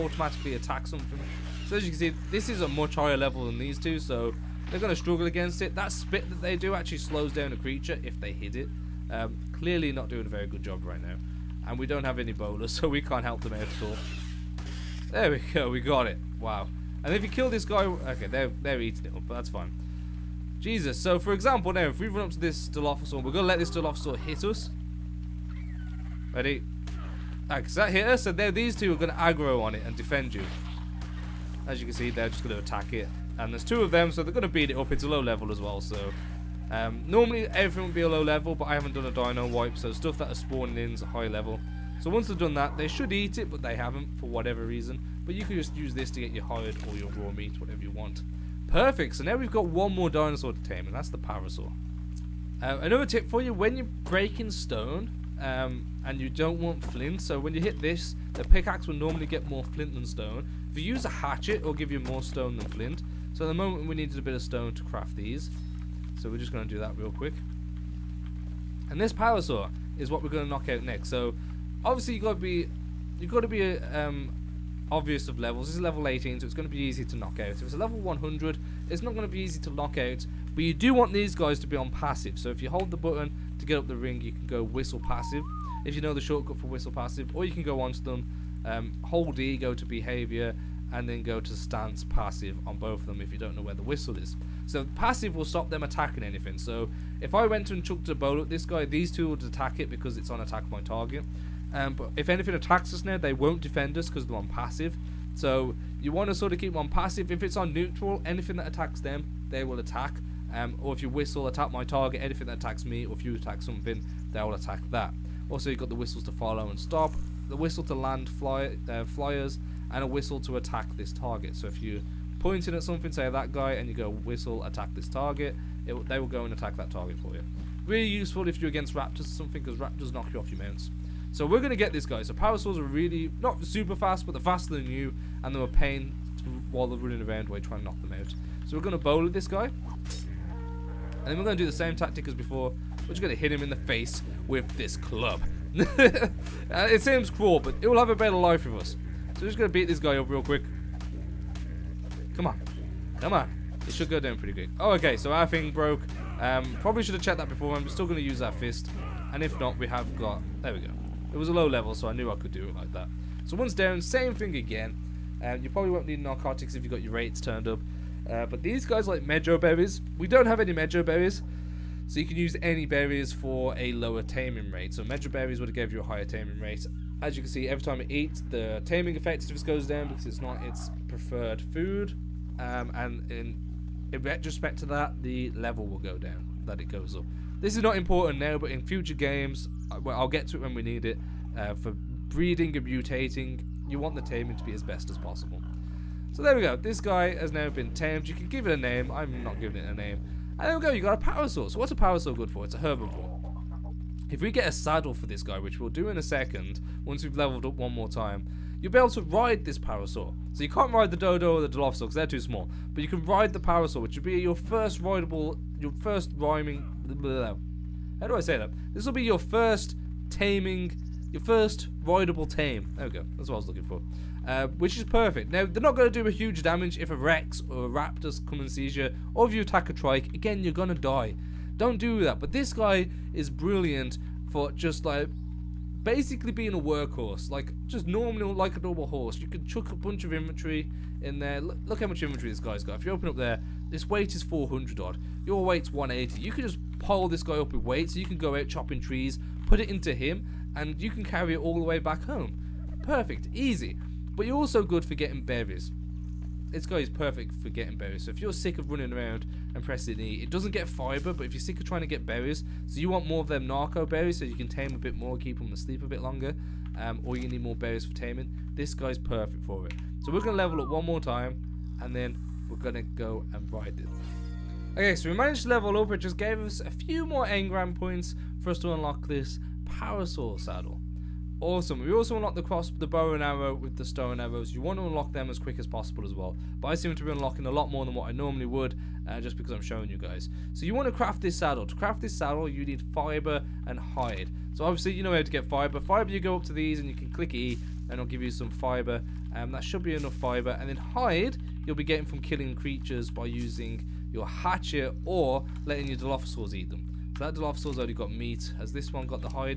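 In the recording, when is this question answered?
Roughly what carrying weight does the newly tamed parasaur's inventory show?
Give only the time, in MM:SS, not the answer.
04:04.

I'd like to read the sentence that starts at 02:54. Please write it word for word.
So Mejo berries would have gave you a higher taming rate.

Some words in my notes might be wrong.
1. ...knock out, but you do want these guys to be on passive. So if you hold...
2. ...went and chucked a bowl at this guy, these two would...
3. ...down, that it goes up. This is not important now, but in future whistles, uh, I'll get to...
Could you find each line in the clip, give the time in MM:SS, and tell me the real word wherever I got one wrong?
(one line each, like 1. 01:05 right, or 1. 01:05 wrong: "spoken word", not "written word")
1. 01:19 right
2. 01:37 right
3. 03:06 wrong: "games", not "whistles".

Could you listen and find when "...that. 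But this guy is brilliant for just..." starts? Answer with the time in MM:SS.
03:52.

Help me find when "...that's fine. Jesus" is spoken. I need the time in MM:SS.
00:19.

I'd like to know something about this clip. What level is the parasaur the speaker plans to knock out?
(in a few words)
18.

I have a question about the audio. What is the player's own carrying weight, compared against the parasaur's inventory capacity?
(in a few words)
180.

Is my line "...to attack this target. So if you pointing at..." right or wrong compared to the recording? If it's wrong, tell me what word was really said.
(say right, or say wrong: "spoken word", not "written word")
right.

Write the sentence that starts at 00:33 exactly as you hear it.
And there's two of them, so they're going to beat it up.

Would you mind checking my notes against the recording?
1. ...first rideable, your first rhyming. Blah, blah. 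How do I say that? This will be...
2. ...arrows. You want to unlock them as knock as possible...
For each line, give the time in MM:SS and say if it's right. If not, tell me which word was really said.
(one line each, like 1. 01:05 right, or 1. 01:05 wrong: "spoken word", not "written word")
1. 03:34 right
2. 04:44 wrong: "quick", not "knock".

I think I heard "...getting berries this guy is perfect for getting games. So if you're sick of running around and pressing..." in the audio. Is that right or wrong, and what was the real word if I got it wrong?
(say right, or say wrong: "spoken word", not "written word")
wrong: "berries", not "games".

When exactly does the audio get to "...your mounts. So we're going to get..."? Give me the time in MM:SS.
02:10.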